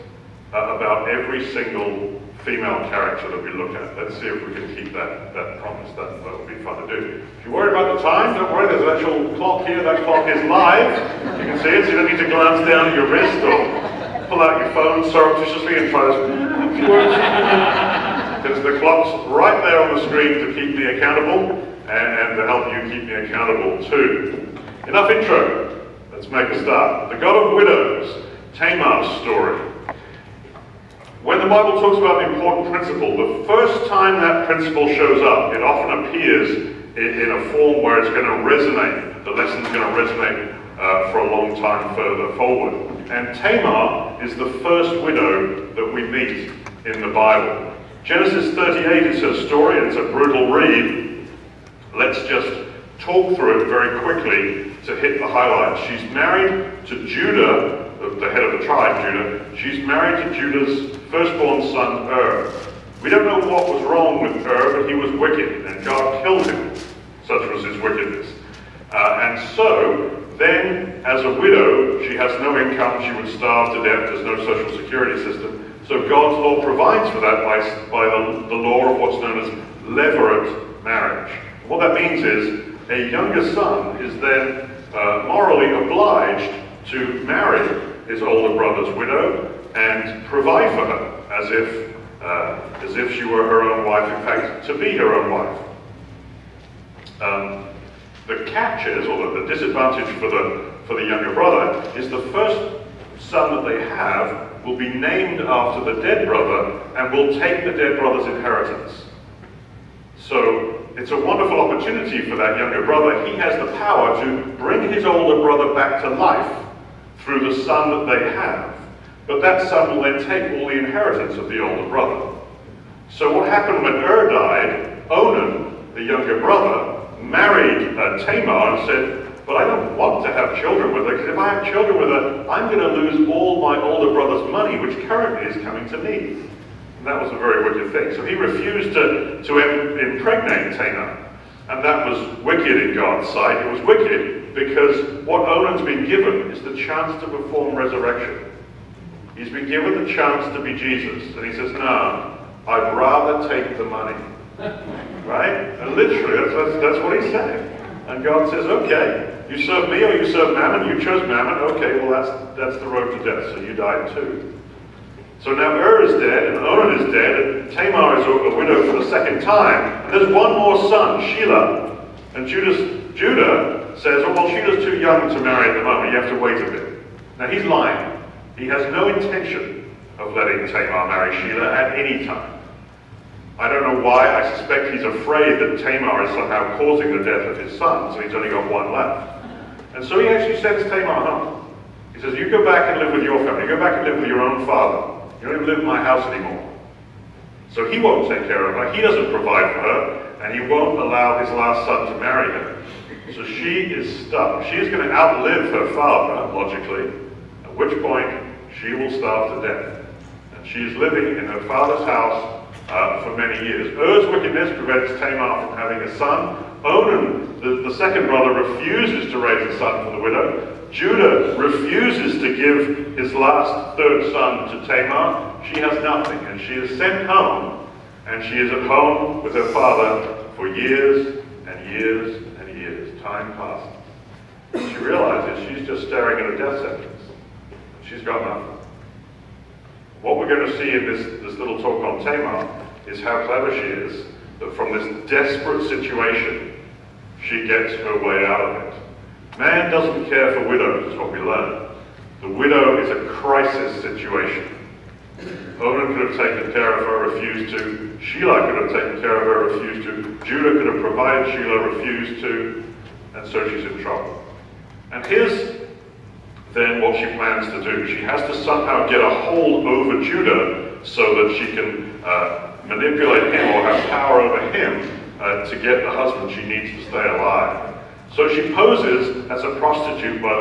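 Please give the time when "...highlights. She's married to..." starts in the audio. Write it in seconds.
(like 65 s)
55 s.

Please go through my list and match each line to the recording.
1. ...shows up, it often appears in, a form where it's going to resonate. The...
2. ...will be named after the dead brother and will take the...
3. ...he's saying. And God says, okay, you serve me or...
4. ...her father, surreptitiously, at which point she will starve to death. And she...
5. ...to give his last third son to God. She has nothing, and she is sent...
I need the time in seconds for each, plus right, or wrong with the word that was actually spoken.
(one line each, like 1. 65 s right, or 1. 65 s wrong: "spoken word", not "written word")
1. 34 s right
2. 104 s right
3. 157 s right
4. 205 s wrong: "logically", not "surreptitiously"
5. 222 s wrong: "Tamar", not "God".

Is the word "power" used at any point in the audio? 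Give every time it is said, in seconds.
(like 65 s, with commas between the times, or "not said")
113 s, 274 s.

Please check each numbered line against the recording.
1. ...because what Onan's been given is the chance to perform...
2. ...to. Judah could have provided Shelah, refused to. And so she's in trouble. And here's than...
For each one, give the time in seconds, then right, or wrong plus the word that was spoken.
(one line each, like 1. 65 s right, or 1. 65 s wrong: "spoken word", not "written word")
1. 144 s right
2. 260 s right.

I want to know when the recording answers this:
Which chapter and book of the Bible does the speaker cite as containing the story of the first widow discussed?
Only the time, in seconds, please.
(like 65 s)
48 s.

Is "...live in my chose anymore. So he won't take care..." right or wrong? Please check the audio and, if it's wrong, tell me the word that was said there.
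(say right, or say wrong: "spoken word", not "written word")
wrong: "house", not "chose".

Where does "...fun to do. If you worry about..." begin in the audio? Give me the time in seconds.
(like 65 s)
6 s.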